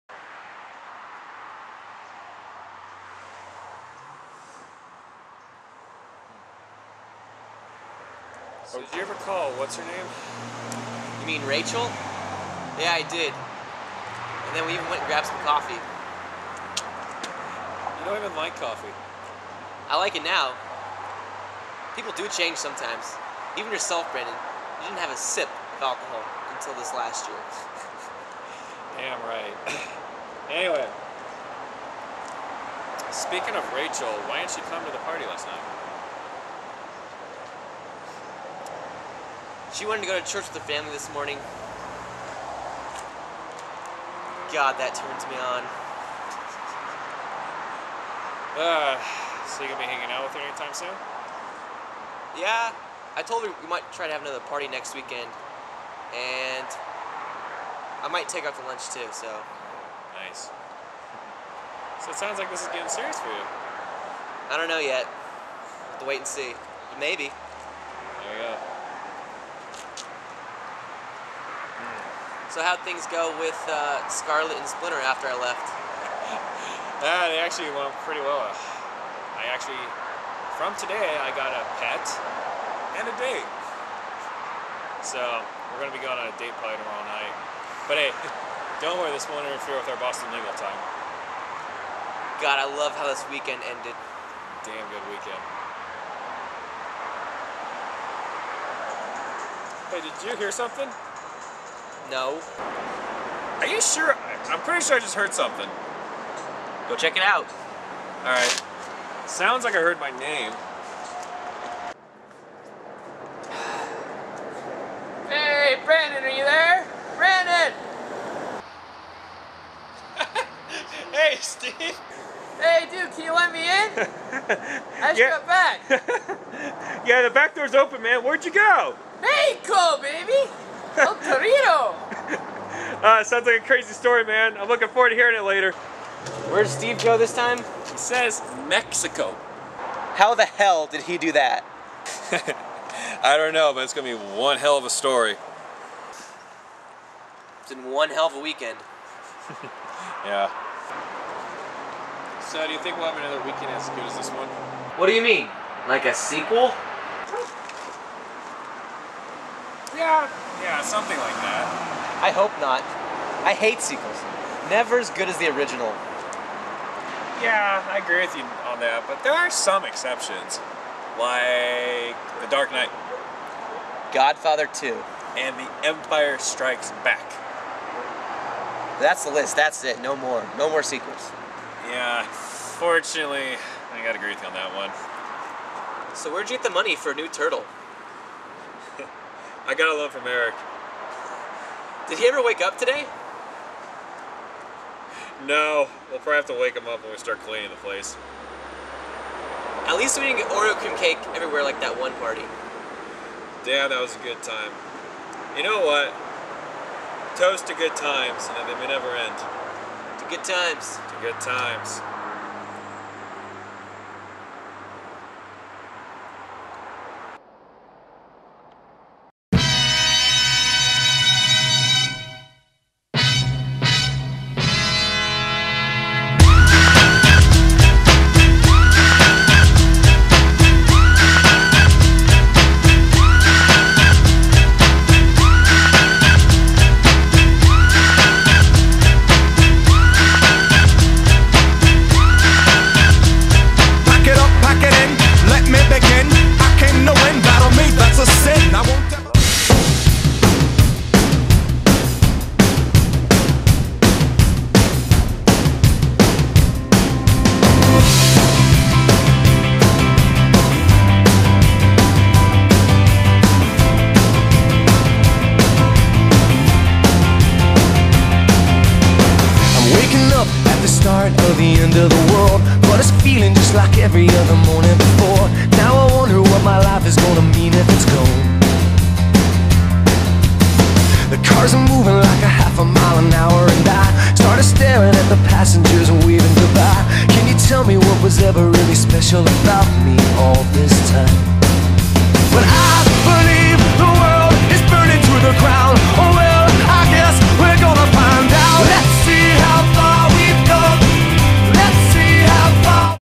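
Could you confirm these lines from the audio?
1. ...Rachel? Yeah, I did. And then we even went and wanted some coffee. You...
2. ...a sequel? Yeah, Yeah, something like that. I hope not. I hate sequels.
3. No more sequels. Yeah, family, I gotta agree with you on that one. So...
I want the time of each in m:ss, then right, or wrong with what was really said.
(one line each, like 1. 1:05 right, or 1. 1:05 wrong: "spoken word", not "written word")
1. 0:11 wrong: "grabbed", not "wanted"
2. 2:36 right
3. 3:00 wrong: "fortunately", not "family".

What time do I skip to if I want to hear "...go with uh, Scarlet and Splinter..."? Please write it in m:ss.
1:13.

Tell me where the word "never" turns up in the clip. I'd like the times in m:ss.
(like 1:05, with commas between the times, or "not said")
2:44, 3:28.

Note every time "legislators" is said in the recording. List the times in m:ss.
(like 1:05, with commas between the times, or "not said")
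not said.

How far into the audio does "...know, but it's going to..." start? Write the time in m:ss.
2:23.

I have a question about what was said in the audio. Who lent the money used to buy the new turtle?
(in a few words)
Eric.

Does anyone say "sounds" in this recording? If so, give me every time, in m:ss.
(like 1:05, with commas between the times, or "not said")
1:02, 1:49, 2:13.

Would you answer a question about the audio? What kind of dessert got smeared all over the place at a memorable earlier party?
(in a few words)
Oreo cream cake.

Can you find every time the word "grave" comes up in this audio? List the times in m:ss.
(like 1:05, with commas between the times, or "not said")
not said.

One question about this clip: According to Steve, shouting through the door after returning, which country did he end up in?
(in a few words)
Mexico.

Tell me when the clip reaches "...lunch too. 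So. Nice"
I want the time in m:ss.
0:58.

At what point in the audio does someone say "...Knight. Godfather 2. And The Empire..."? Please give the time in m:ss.
2:52.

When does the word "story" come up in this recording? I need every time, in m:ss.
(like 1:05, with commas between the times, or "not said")
2:13, 2:24.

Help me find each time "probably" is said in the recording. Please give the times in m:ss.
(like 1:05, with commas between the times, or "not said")
1:26, 3:16.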